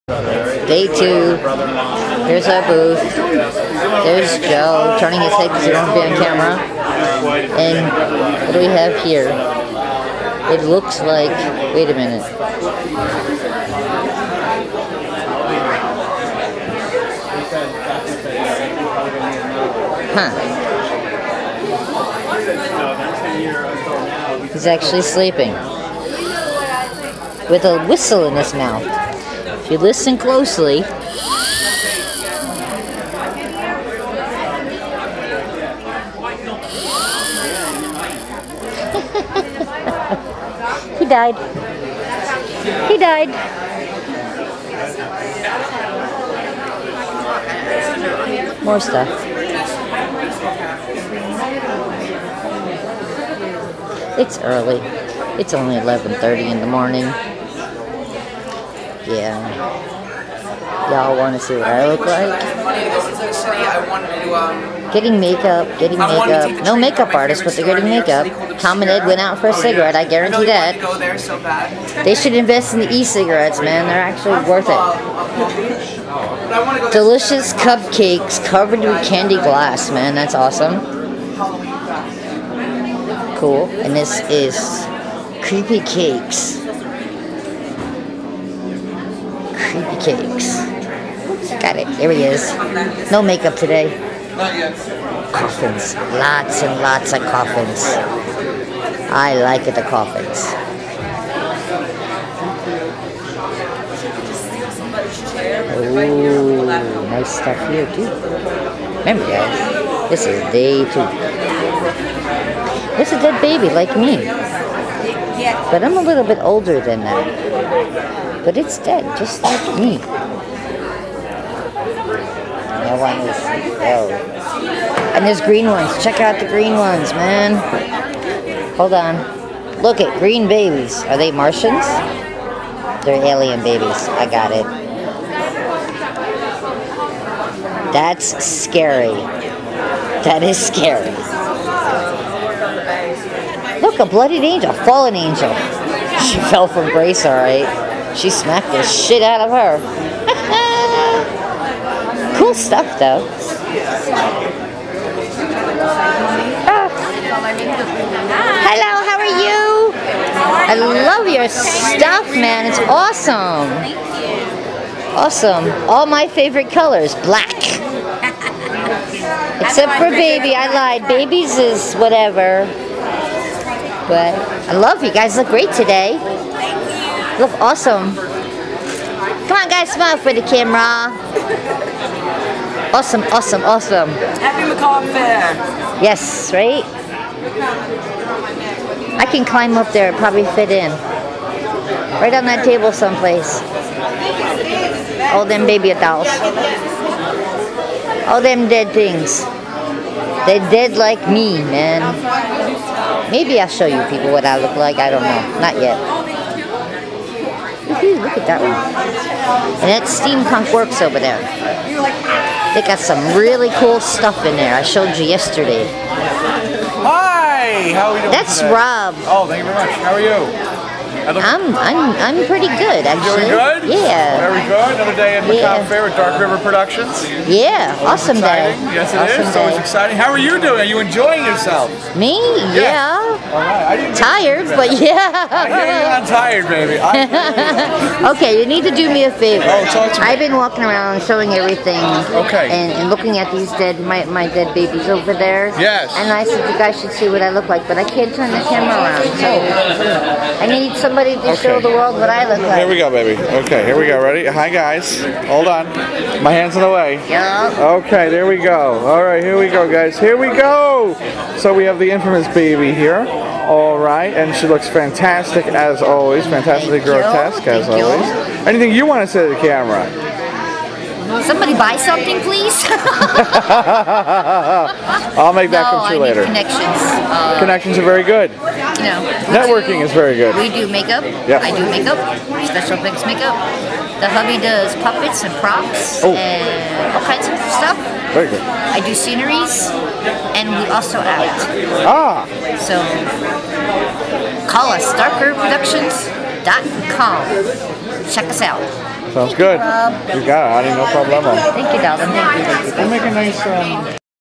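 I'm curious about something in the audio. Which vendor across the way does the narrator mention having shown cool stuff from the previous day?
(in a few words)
Steampunk Works.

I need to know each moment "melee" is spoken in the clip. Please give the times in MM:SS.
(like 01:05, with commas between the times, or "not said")
not said.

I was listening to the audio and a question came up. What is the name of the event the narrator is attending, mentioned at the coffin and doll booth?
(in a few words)
Macabre Faire.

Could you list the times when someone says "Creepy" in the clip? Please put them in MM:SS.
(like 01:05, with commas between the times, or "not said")
01:25, 01:29.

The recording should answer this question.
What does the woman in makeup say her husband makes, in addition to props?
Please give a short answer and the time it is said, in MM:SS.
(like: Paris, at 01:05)
Puppets, at 04:45.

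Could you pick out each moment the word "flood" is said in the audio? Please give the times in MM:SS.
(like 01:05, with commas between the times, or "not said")
not said.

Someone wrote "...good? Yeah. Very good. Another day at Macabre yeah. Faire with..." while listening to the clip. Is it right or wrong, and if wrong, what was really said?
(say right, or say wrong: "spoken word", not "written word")
right.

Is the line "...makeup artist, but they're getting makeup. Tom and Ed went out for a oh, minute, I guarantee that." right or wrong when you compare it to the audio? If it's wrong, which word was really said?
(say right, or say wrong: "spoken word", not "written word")
wrong: "cigarette", not "minute".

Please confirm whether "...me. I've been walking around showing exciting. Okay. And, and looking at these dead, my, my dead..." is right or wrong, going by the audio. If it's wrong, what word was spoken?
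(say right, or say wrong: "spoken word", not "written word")
wrong: "everything", not "exciting".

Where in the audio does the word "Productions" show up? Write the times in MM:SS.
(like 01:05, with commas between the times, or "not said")
03:46, 04:55.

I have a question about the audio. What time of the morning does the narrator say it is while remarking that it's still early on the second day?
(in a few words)
11:30.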